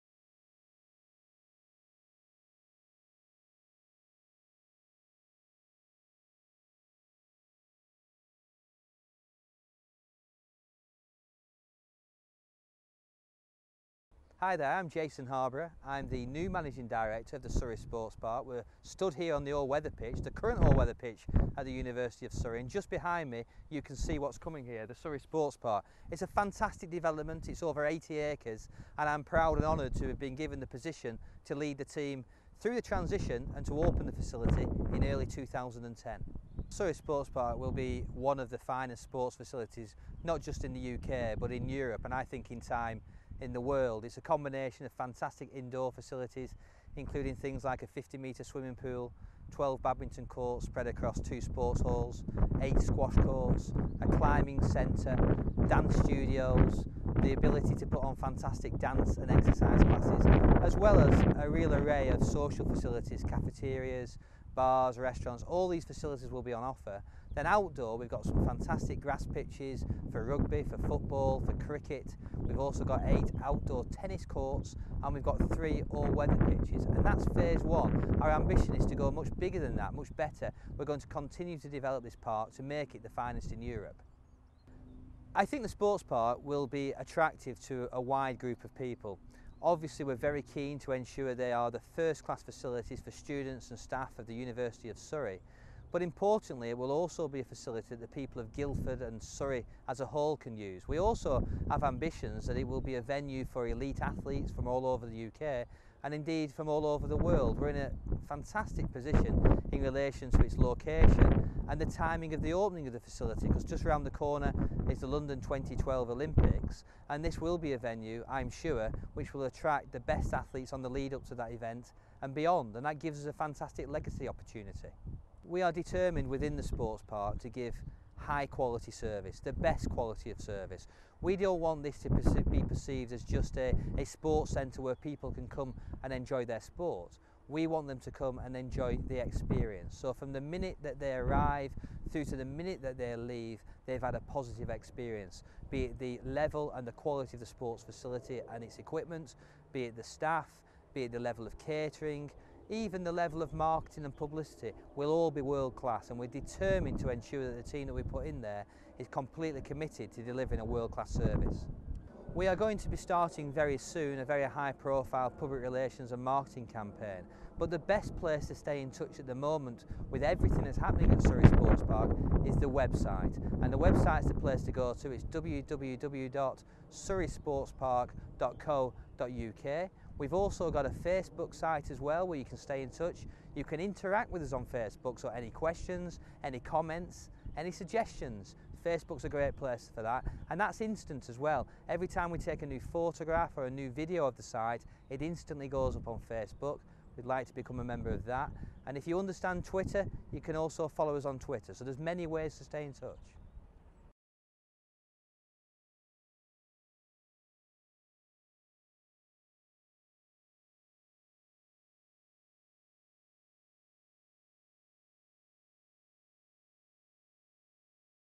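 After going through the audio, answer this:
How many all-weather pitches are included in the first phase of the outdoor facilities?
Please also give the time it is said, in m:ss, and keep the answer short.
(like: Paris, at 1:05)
3, at 1:15.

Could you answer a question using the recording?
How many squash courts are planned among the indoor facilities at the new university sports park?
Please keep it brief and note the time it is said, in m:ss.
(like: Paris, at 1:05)
8, at 0:52.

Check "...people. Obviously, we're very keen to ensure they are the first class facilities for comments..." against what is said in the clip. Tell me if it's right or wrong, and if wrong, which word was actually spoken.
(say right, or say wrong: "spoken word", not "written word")
wrong: "students", not "comments".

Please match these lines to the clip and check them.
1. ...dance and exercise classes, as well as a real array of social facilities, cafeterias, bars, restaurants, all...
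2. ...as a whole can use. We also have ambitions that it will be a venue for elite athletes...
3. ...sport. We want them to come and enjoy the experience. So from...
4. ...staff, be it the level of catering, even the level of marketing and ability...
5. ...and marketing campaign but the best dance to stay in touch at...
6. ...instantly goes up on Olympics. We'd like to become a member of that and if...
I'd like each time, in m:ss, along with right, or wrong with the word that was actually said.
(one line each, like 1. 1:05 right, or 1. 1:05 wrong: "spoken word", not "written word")
1. 0:58 right
2. 1:39 right
3. 2:16 right
4. 2:30 wrong: "publicity", not "ability"
5. 2:46 wrong: "place", not "dance"
6. 3:15 wrong: "Facebook", not "Olympics".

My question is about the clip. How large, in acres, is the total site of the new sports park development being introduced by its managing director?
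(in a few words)
over 80 acres.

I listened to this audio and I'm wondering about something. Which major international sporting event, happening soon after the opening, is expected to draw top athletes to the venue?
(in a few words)
London 2012 Olympics.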